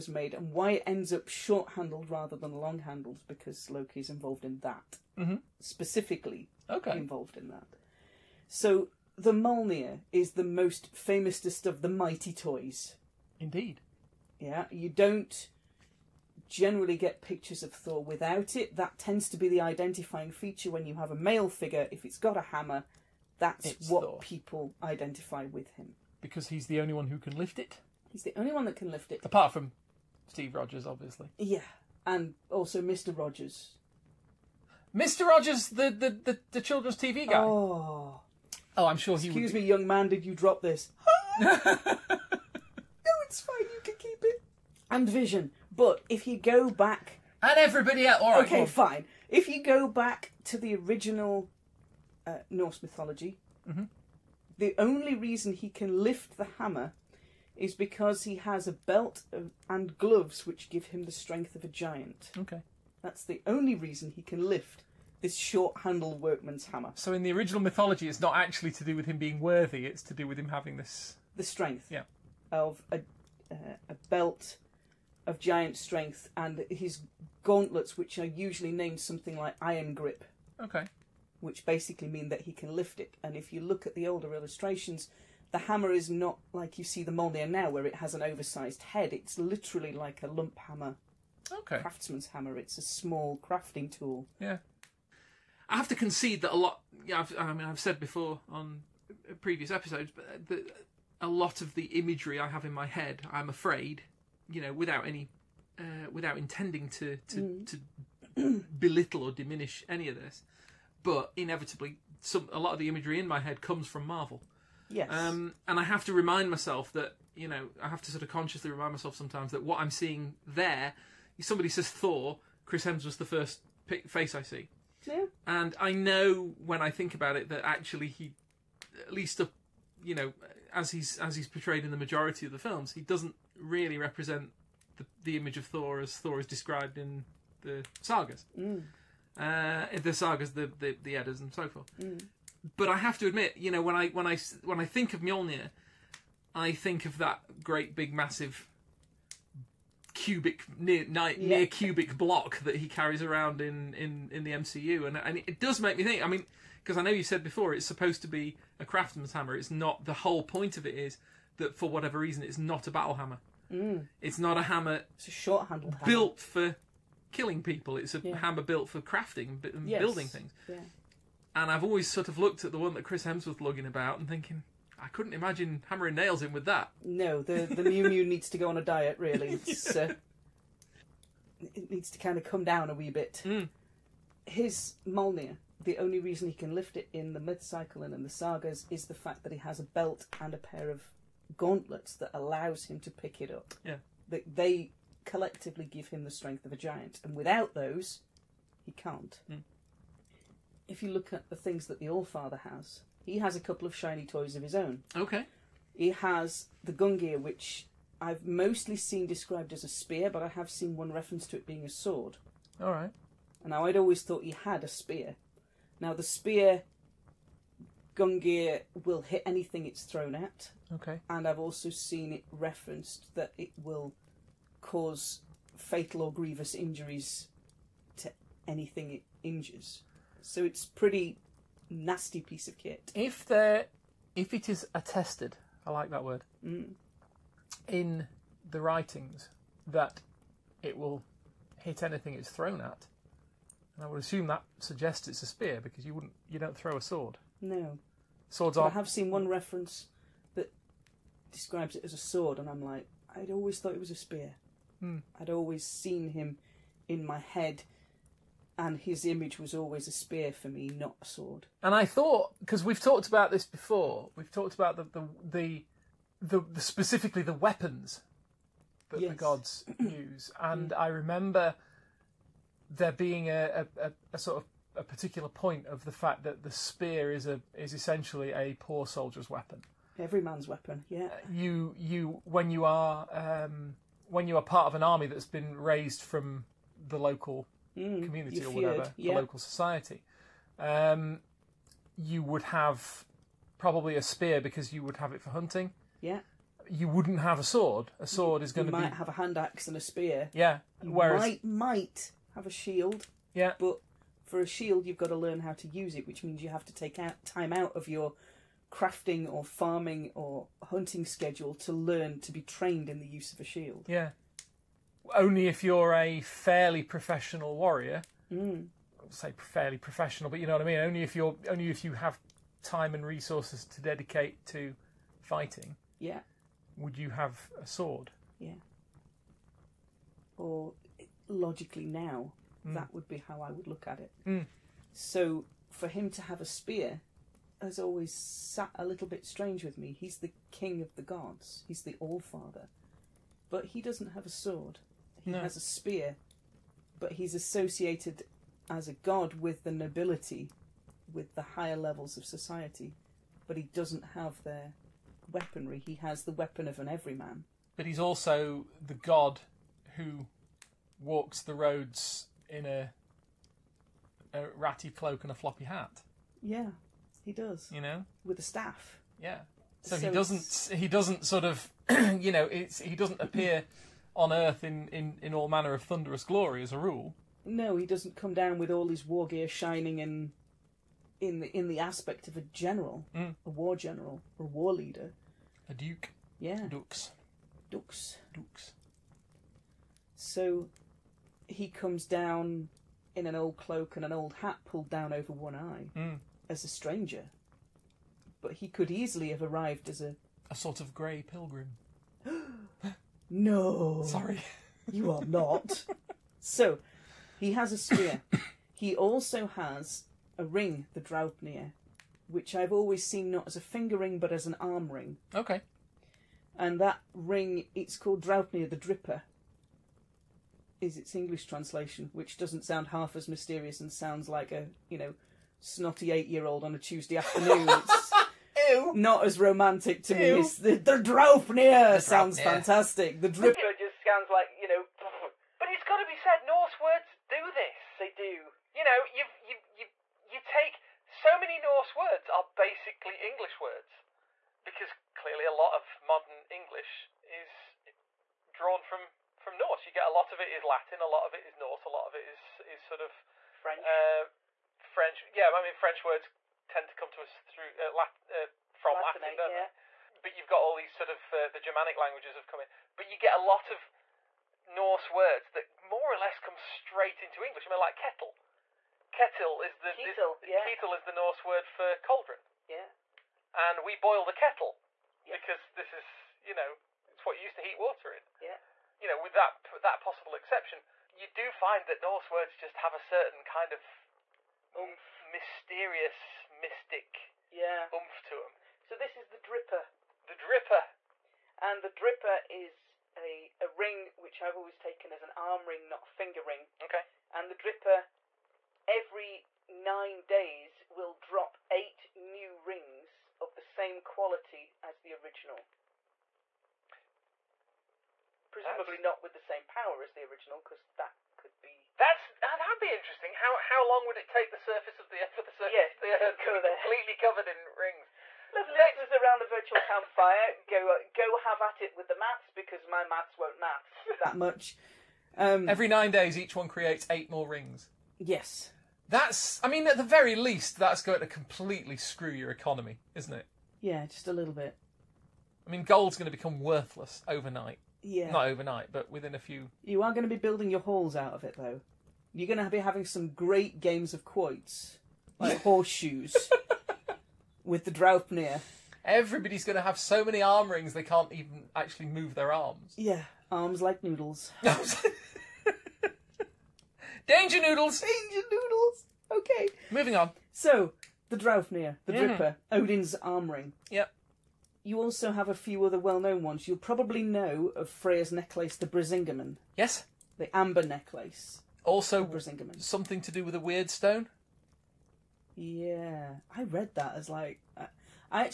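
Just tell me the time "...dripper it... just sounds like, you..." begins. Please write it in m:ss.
7:13.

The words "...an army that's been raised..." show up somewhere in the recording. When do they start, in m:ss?
4:44.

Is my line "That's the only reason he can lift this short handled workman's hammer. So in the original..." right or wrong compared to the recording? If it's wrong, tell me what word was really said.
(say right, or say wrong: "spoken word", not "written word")
right.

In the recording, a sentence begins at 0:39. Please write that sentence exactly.
me, young man, did you drop this?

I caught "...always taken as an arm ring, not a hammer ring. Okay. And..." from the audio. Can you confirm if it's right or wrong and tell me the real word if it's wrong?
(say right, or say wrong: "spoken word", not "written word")
wrong: "finger", not "hammer".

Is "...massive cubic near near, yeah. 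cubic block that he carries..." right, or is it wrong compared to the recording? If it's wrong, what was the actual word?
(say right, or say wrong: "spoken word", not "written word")
right.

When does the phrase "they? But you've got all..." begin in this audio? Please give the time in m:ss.
7:40.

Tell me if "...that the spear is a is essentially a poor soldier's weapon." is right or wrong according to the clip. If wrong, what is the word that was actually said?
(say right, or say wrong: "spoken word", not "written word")
right.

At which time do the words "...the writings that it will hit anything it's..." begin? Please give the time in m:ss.
3:58.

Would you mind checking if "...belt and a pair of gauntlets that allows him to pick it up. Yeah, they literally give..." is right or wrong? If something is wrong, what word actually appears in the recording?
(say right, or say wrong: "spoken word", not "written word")
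wrong: "collectively", not "literally".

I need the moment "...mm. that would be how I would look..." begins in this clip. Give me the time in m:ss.
5:32.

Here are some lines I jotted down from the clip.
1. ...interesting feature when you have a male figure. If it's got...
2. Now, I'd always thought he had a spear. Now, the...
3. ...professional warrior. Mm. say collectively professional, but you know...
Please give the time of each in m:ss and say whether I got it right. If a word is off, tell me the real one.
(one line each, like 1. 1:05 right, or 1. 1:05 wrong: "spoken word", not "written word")
1. 0:19 wrong: "identifying", not "interesting"
2. 3:33 right
3. 5:17 wrong: "fairly", not "collectively".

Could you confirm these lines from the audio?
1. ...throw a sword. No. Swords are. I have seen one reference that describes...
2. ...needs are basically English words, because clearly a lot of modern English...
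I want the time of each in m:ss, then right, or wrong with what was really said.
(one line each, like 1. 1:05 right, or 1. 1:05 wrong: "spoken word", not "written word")
1. 4:06 right
2. 7:22 wrong: "words", not "needs".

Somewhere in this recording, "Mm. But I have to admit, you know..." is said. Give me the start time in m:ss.
2:22.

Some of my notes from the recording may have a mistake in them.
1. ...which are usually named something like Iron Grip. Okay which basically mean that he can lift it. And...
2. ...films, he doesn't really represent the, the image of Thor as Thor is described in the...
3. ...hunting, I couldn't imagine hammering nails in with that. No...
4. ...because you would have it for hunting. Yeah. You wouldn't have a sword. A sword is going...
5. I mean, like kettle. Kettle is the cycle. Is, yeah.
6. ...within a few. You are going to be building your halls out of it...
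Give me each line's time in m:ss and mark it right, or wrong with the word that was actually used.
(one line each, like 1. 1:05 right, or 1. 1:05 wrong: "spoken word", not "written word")
1. 1:17 right
2. 2:12 right
3. 2:54 wrong: "thinking", not "hunting"
4. 4:54 right
5. 7:47 wrong: "kettle", not "cycle"
6. 8:59 right.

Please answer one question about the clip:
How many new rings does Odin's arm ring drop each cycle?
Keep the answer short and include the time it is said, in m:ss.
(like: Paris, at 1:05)
8, at 8:21.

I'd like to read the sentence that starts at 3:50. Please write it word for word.
So it's pretty nasty piece of kit.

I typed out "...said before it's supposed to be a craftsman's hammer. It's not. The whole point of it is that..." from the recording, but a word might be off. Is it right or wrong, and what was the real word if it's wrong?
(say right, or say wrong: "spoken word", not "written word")
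right.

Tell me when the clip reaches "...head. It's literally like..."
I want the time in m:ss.
1:28.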